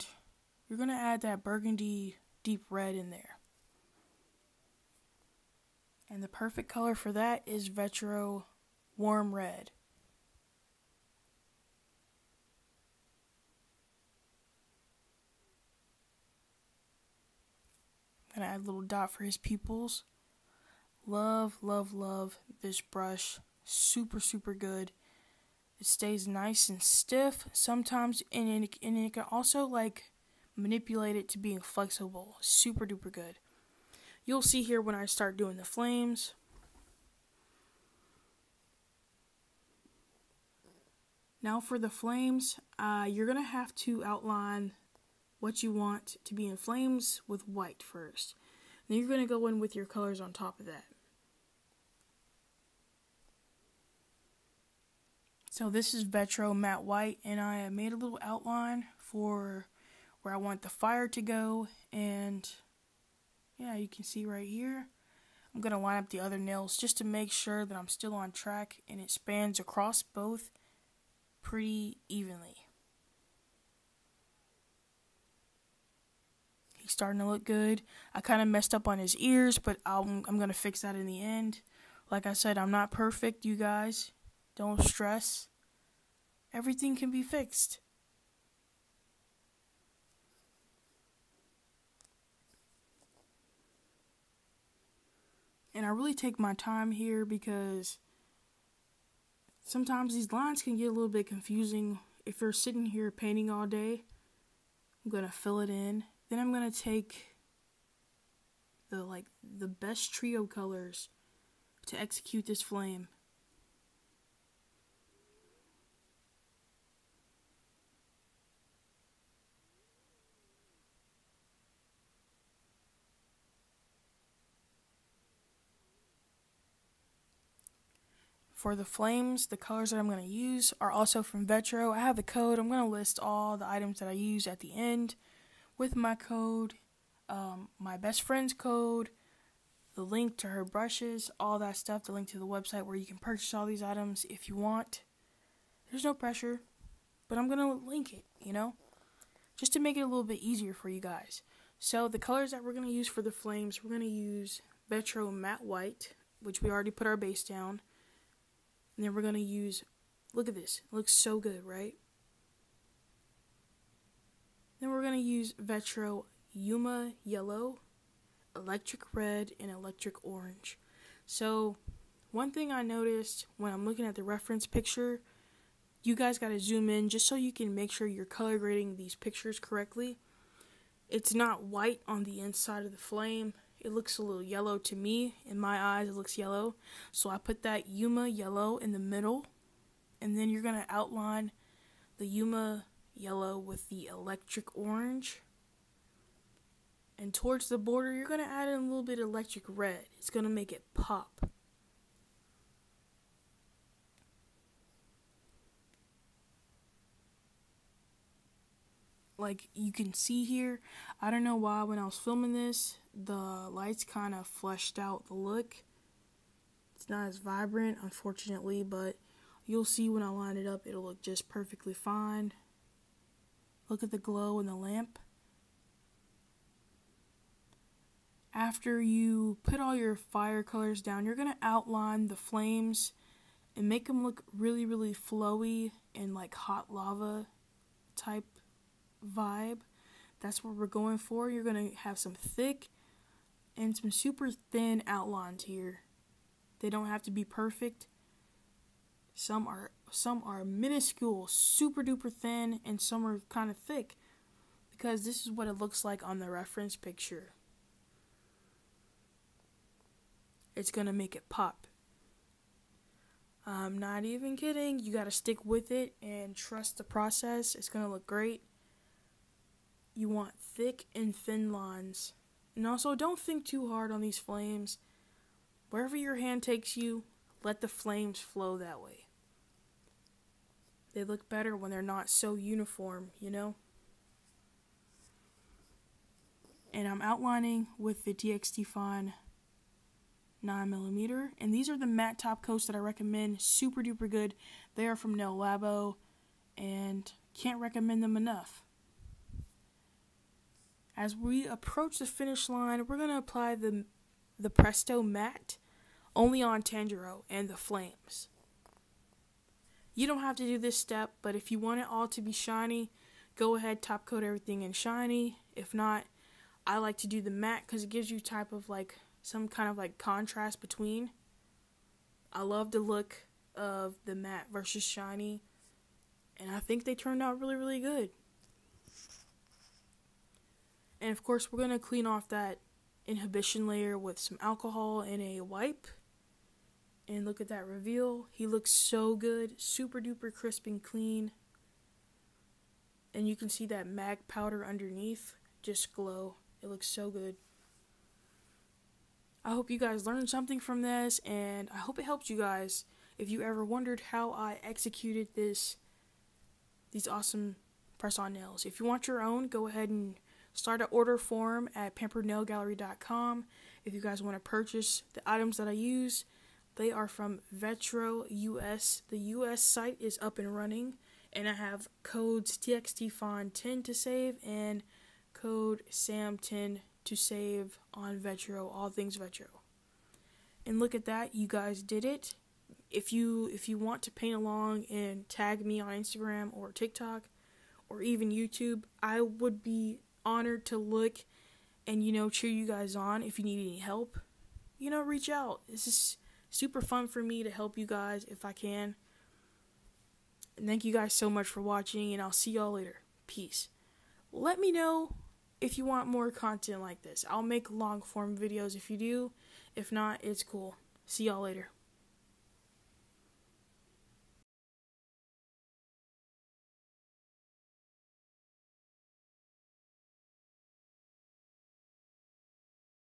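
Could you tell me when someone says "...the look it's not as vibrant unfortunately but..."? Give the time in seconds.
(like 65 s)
215 s.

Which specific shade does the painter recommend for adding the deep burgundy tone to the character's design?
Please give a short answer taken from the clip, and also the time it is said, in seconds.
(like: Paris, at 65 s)
Vetro warm red, at 7 s.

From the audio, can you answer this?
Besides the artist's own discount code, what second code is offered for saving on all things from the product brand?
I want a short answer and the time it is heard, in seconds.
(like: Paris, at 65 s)
SAM10, at 376 s.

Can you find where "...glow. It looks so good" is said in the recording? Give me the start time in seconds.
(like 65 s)
346 s.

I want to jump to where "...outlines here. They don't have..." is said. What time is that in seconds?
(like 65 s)
245 s.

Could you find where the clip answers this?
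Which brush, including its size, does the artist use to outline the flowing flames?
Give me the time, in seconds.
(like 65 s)
288 s.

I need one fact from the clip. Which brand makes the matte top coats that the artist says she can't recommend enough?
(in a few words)
Nail Labo.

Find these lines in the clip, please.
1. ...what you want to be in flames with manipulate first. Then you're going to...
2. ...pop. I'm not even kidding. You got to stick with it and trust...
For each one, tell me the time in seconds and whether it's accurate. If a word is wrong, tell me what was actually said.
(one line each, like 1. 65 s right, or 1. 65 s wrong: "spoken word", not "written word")
1. 45 s wrong: "white", not "manipulate"
2. 261 s right.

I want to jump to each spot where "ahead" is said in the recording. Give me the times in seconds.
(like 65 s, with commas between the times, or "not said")
313 s, 359 s.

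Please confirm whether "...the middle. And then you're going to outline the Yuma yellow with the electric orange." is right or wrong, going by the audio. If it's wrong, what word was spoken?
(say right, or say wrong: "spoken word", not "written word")
right.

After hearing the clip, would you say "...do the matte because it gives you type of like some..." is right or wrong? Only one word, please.
right.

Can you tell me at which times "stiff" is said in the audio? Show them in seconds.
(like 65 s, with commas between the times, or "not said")
26 s.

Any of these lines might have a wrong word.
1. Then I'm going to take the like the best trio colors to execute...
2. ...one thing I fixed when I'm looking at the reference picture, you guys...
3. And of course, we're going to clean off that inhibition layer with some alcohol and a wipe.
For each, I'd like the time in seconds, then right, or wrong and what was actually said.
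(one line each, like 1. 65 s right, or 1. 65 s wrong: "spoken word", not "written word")
1. 106 s right
2. 172 s wrong: "noticed", not "fixed"
3. 331 s right.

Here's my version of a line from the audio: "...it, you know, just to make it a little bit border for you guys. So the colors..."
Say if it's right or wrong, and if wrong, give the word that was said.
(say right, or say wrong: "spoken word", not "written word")
wrong: "easier", not "border".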